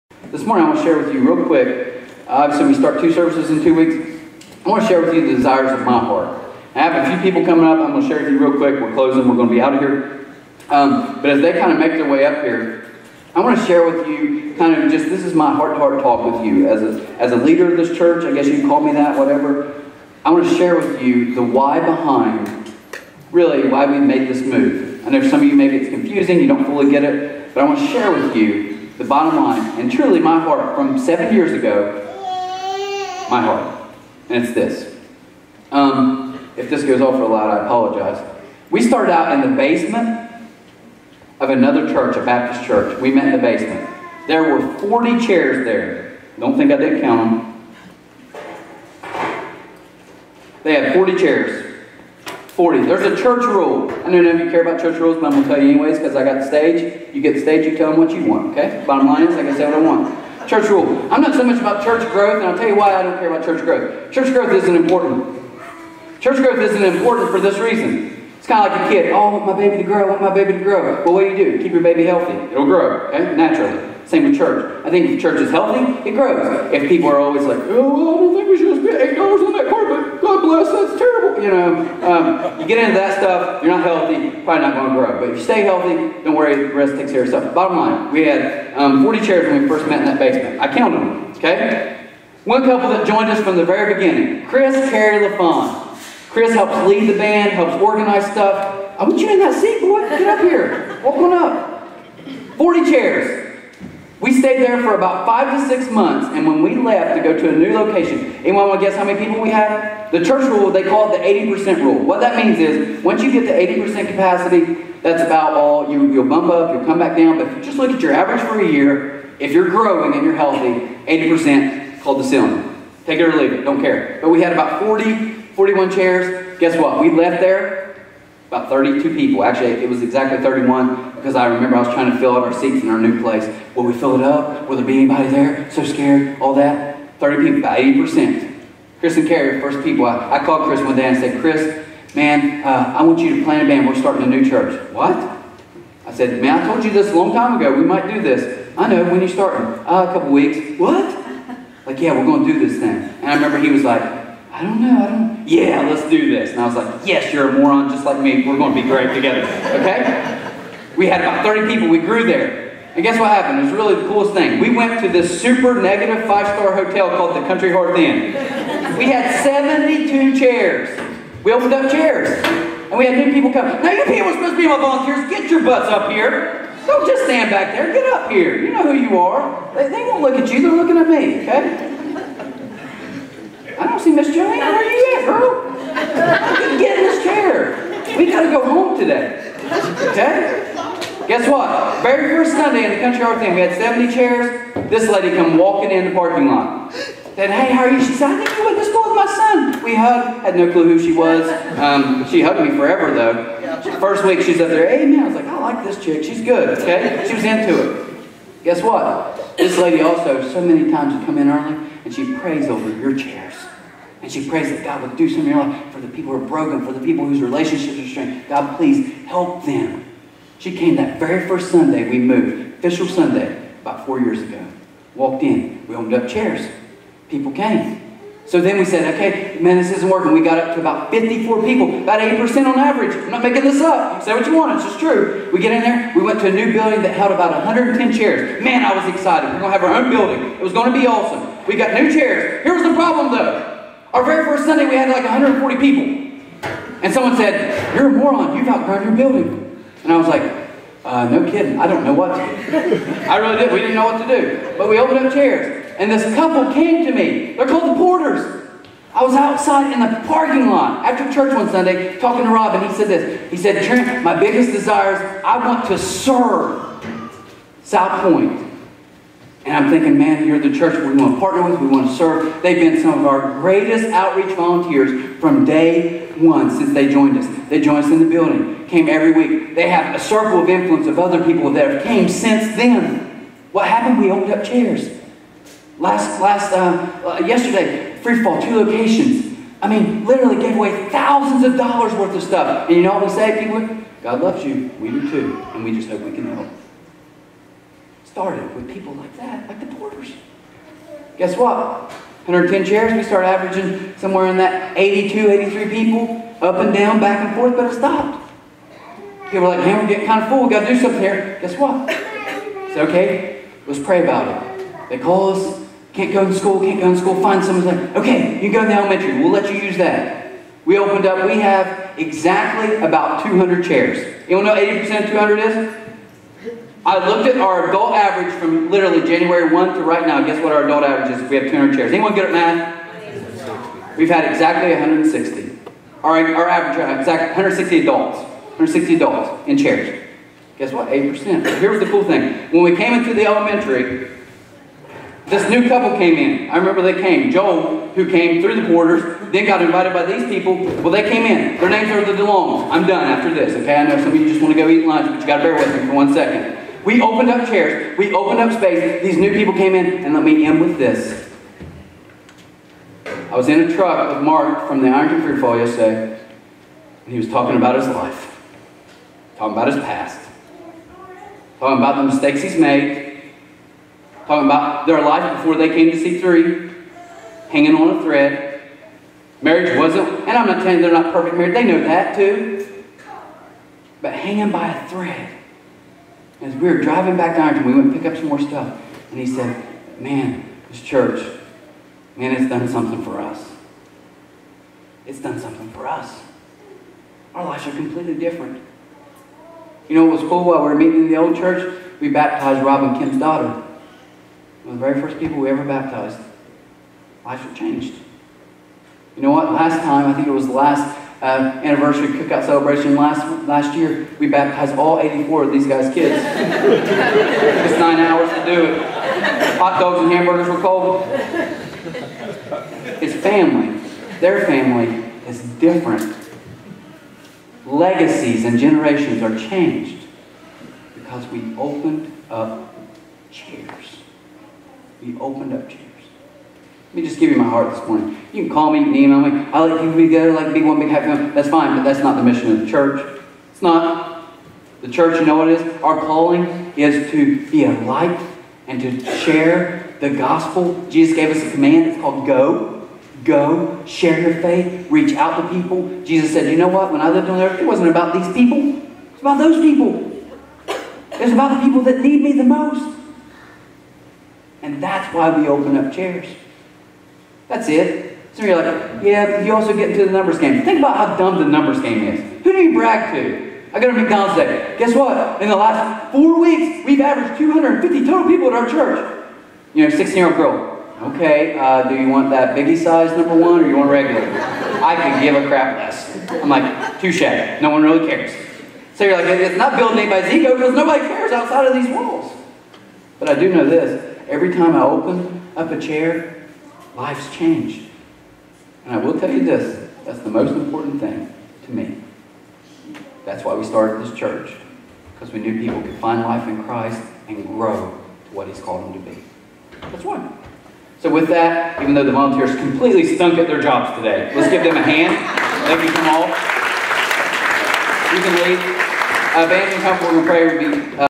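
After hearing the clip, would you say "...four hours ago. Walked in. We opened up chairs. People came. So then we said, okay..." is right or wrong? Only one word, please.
wrong.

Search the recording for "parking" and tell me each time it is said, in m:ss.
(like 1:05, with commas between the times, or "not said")
3:16, 4:20.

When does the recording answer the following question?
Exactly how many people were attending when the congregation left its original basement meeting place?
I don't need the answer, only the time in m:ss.
2:10.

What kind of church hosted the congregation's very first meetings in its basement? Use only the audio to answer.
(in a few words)
Baptist.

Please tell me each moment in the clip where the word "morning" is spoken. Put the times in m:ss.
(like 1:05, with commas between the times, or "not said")
0:00, 7:18.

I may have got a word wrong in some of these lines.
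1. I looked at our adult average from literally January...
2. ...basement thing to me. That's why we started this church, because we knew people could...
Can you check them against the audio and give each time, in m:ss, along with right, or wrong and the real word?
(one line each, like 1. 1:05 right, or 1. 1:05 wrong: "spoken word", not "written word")
1. 5:27 right
2. 8:20 wrong: "important", not "basement".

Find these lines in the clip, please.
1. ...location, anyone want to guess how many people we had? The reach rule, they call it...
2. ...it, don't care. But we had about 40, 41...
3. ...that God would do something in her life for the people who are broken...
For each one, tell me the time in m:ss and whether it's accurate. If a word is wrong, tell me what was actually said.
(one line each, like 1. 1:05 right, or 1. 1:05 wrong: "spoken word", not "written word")
1. 1:47 wrong: "church", not "reach"
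2. 2:03 right
3. 3:34 right.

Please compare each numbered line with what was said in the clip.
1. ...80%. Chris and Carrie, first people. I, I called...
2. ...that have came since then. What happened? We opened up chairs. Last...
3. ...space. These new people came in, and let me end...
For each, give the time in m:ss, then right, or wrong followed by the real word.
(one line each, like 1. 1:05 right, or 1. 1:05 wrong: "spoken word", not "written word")
1. 2:17 right
2. 4:41 right
3. 5:58 right.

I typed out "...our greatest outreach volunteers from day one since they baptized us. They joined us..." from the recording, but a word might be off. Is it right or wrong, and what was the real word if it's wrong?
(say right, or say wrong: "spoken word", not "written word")
wrong: "joined", not "baptized".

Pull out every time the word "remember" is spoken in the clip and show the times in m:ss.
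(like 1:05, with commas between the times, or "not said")
2:11, 2:33, 5:46.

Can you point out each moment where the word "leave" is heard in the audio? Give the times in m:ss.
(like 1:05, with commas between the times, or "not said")
2:03, 8:38.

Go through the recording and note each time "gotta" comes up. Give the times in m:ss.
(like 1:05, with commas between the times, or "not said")
3:08, 5:10.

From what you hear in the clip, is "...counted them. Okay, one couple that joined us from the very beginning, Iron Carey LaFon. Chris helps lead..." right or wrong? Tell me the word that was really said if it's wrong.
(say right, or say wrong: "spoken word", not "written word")
wrong: "Chris", not "Iron".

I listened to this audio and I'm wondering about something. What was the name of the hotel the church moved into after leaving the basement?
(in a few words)
Country Hearth Inn.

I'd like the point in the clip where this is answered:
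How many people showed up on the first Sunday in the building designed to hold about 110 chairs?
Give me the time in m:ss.
4:05.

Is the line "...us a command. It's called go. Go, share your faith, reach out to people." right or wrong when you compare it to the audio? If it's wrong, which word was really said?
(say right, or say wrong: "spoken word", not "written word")
right.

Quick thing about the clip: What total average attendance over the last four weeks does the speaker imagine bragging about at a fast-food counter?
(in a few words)
250.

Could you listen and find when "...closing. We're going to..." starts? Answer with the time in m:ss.
0:08.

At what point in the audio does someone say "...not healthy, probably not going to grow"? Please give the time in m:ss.
1:23.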